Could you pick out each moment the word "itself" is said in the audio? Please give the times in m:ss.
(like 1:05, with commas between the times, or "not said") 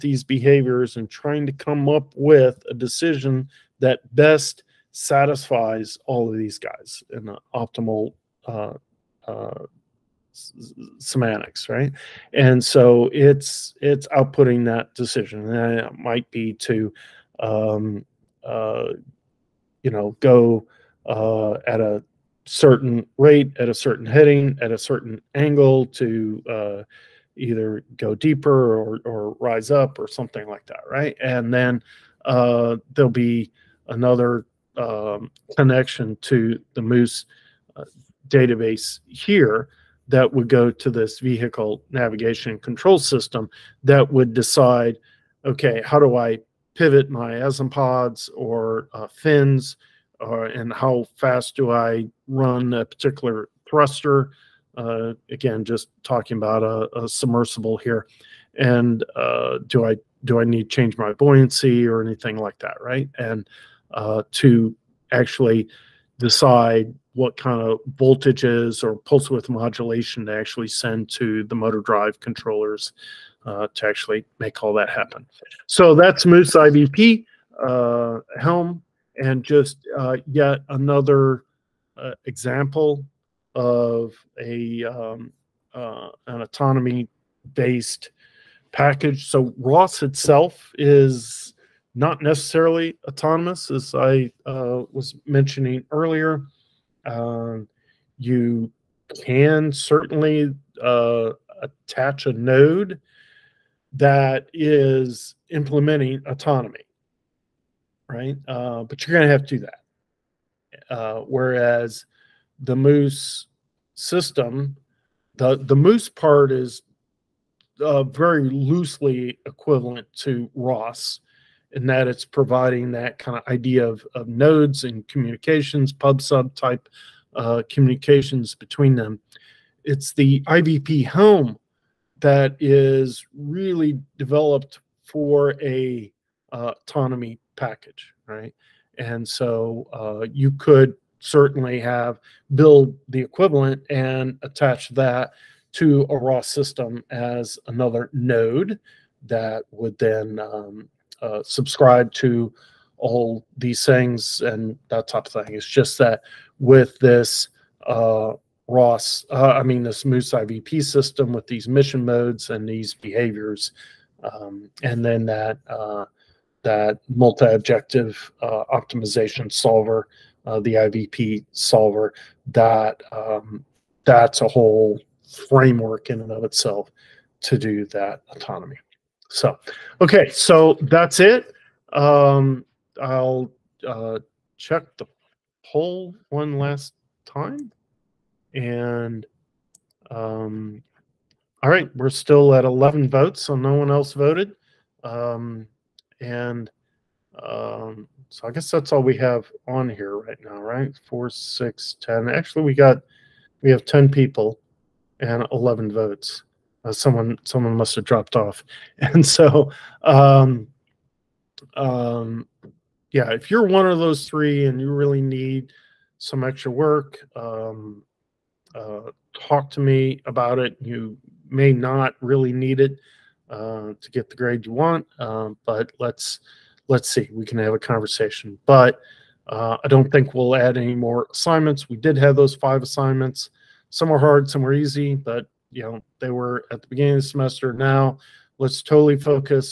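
1:30, 2:56.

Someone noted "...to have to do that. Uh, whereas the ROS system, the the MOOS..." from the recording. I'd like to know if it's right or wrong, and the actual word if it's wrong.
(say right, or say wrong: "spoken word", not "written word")
wrong: "MOOS", not "ROS".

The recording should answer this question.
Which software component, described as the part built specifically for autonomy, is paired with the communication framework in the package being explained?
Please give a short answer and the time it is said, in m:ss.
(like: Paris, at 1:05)
IvP Helm, at 2:10.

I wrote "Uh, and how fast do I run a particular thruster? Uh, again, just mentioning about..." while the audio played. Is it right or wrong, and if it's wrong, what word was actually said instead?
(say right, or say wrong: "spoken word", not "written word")
wrong: "talking", not "mentioning".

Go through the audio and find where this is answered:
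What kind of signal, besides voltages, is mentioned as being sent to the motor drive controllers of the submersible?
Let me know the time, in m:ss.
1:08.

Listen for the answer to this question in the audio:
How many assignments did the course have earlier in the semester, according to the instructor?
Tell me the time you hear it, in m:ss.
3:52.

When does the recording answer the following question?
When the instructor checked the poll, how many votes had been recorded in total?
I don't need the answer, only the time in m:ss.
3:12.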